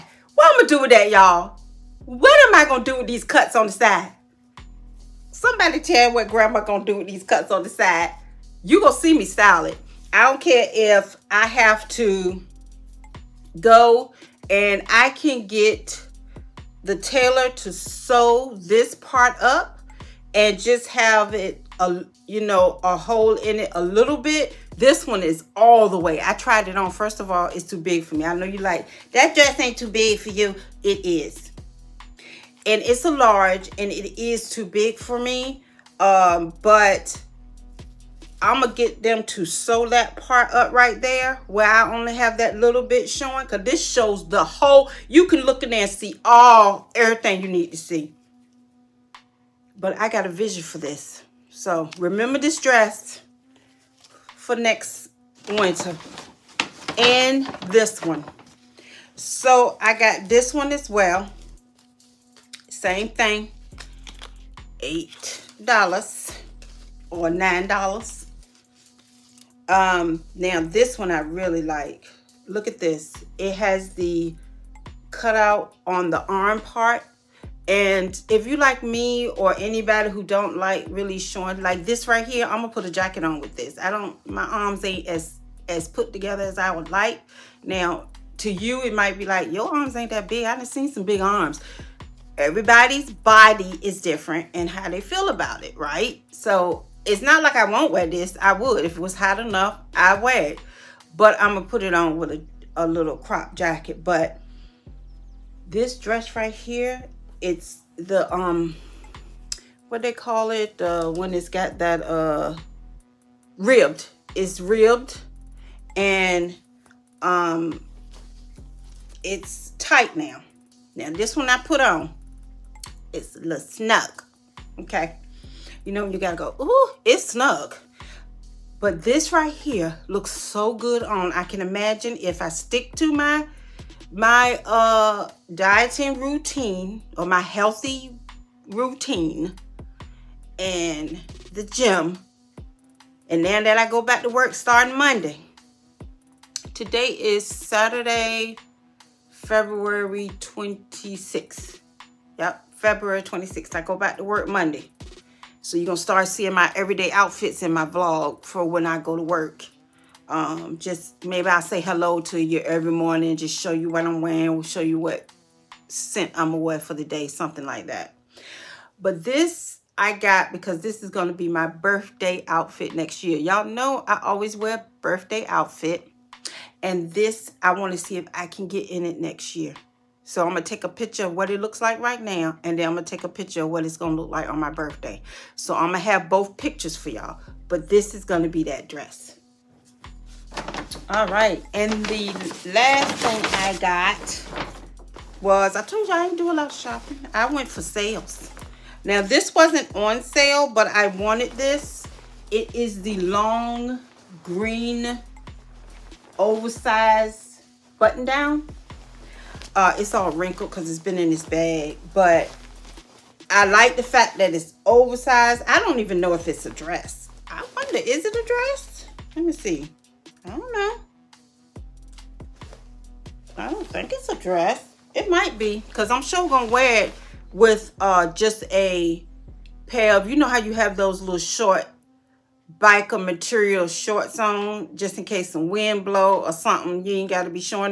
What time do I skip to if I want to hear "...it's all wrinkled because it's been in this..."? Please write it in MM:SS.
03:29.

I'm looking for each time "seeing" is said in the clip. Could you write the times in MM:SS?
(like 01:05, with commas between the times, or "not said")
02:36.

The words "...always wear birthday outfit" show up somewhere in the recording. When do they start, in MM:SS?
02:54.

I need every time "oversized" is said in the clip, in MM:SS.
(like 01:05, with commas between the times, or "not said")
03:26, 03:34.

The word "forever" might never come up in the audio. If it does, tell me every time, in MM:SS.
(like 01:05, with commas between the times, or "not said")
not said.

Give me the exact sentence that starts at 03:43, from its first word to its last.
I don't think it's a dress.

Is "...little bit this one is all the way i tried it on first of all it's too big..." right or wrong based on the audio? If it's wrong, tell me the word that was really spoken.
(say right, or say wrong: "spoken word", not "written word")
right.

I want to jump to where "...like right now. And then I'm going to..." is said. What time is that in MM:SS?
03:01.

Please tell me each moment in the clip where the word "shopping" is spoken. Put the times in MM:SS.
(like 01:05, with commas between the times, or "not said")
03:16.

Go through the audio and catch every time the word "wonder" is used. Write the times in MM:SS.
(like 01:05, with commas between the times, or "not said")
03:37.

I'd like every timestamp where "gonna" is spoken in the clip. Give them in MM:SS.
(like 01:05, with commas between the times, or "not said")
00:38, 01:22, 02:46.